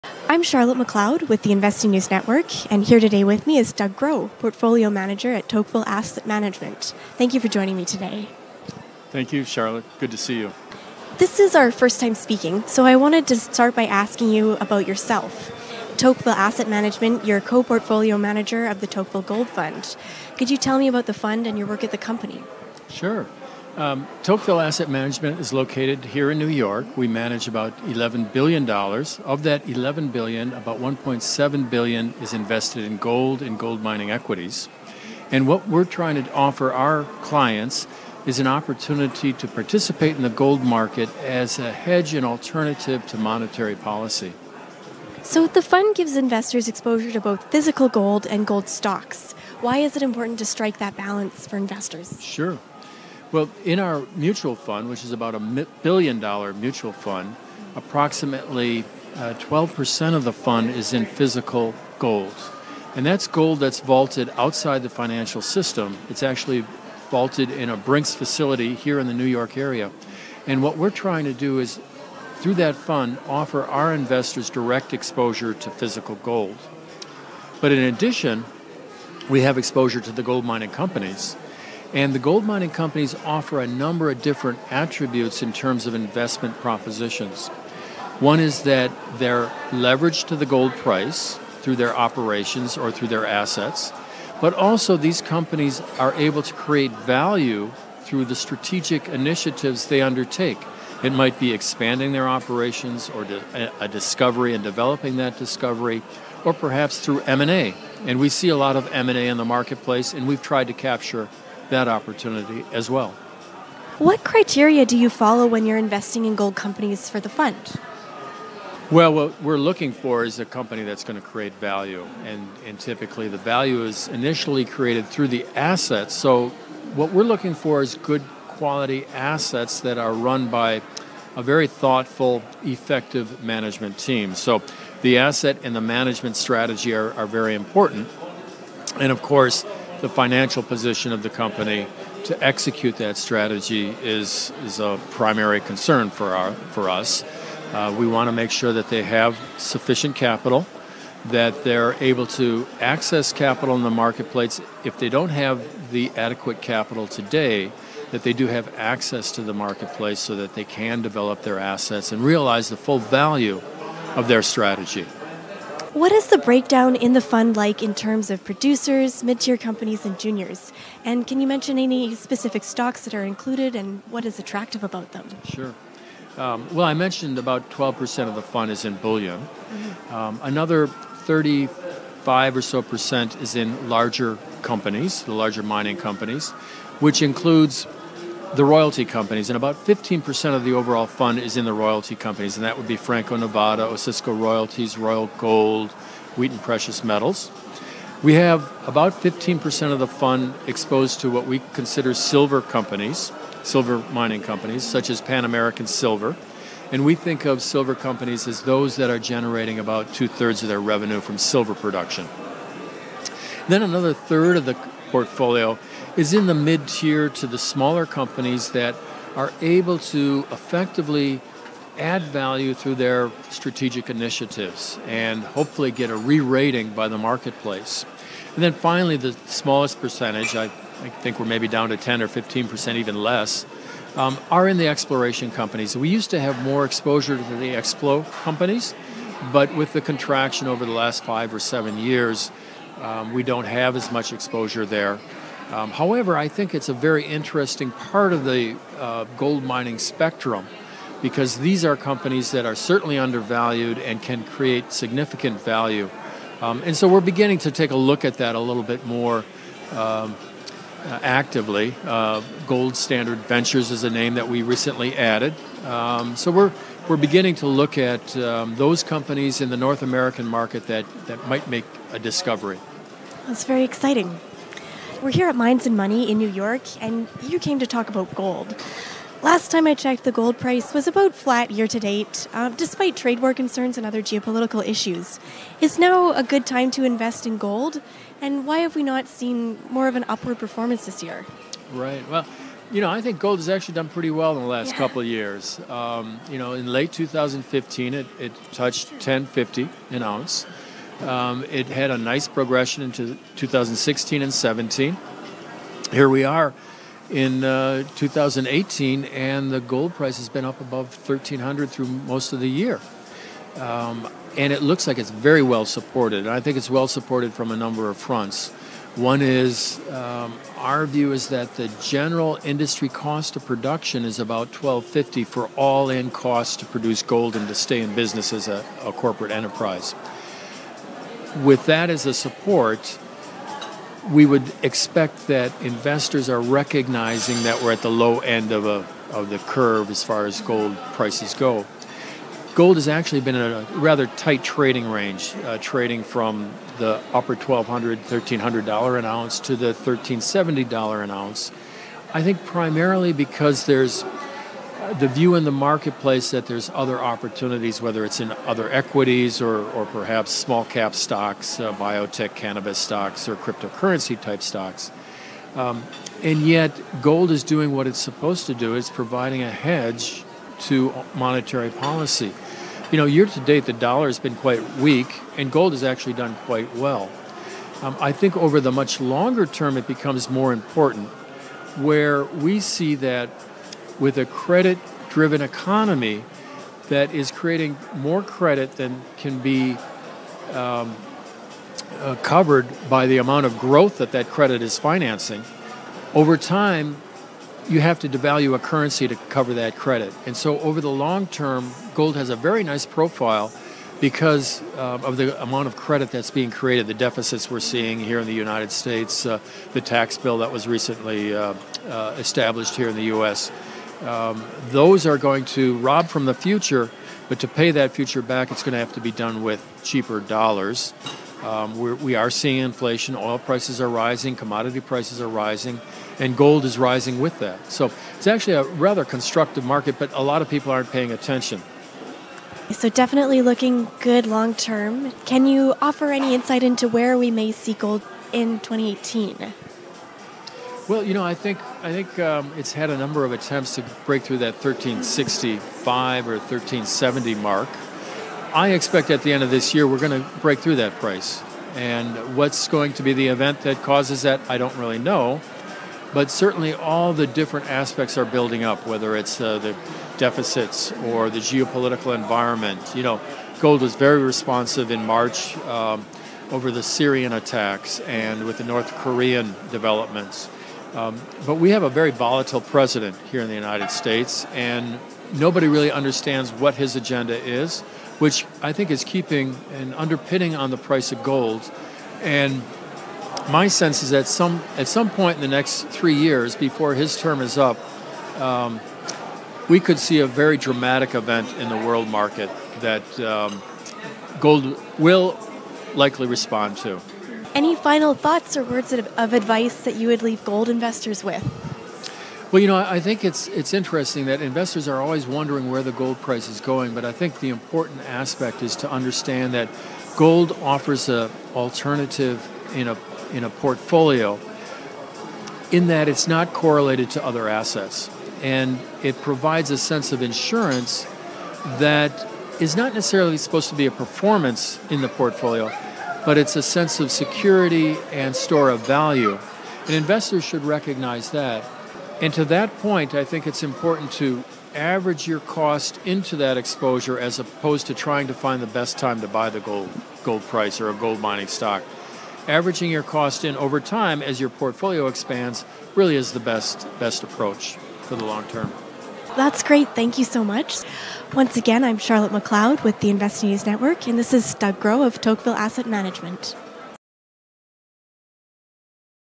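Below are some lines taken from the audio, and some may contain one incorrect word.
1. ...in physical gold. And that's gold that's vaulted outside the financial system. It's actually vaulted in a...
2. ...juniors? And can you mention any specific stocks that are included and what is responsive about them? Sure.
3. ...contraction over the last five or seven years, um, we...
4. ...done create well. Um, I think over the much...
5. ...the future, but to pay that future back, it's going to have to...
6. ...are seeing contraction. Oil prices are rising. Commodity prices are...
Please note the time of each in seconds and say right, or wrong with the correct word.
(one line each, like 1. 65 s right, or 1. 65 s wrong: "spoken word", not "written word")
1. 60 s right
2. 170 s wrong: "attractive", not "responsive"
3. 240 s right
4. 376 s wrong: "quite", not "create"
5. 416 s right
6. 422 s wrong: "inflation", not "contraction".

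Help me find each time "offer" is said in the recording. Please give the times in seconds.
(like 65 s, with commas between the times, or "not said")
36 s, 73 s, 83 s, 436 s, 510 s.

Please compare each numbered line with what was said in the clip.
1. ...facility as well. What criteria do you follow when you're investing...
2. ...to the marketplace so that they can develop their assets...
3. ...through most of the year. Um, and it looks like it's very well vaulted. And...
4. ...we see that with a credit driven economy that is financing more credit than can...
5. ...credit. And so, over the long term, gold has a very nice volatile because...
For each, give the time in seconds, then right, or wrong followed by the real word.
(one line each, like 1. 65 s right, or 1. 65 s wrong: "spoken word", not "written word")
1. 111 s wrong: "opportunity", not "facility"
2. 159 s right
3. 311 s wrong: "supported", not "vaulted"
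4. 382 s wrong: "creating", not "financing"
5. 399 s wrong: "profile", not "volatile".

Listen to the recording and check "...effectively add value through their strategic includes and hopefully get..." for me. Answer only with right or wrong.
wrong.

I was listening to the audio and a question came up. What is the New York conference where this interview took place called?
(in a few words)
Mines and Money.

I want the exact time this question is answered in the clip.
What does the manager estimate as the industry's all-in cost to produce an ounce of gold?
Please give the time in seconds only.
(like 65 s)
324 s.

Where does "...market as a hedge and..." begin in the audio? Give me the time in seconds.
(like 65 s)
40 s.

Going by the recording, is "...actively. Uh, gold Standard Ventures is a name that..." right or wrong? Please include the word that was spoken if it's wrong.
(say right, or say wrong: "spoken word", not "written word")
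right.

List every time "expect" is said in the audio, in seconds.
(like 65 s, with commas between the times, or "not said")
334 s, 448 s.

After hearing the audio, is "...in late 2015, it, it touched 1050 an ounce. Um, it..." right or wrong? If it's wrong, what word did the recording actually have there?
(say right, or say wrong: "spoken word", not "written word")
right.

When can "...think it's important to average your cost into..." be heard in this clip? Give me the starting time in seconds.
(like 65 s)
533 s.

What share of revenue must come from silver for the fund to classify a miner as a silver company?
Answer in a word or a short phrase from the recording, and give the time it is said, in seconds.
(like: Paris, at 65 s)
two thirds, at 210 s.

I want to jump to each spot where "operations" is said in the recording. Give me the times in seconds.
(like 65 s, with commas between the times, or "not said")
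91 s, 102 s.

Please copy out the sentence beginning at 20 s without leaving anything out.
Could you tell me about the fund and your work at the company?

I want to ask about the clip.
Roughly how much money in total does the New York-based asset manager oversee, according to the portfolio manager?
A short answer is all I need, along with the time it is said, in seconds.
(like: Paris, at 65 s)
$11 billion, at 27 s.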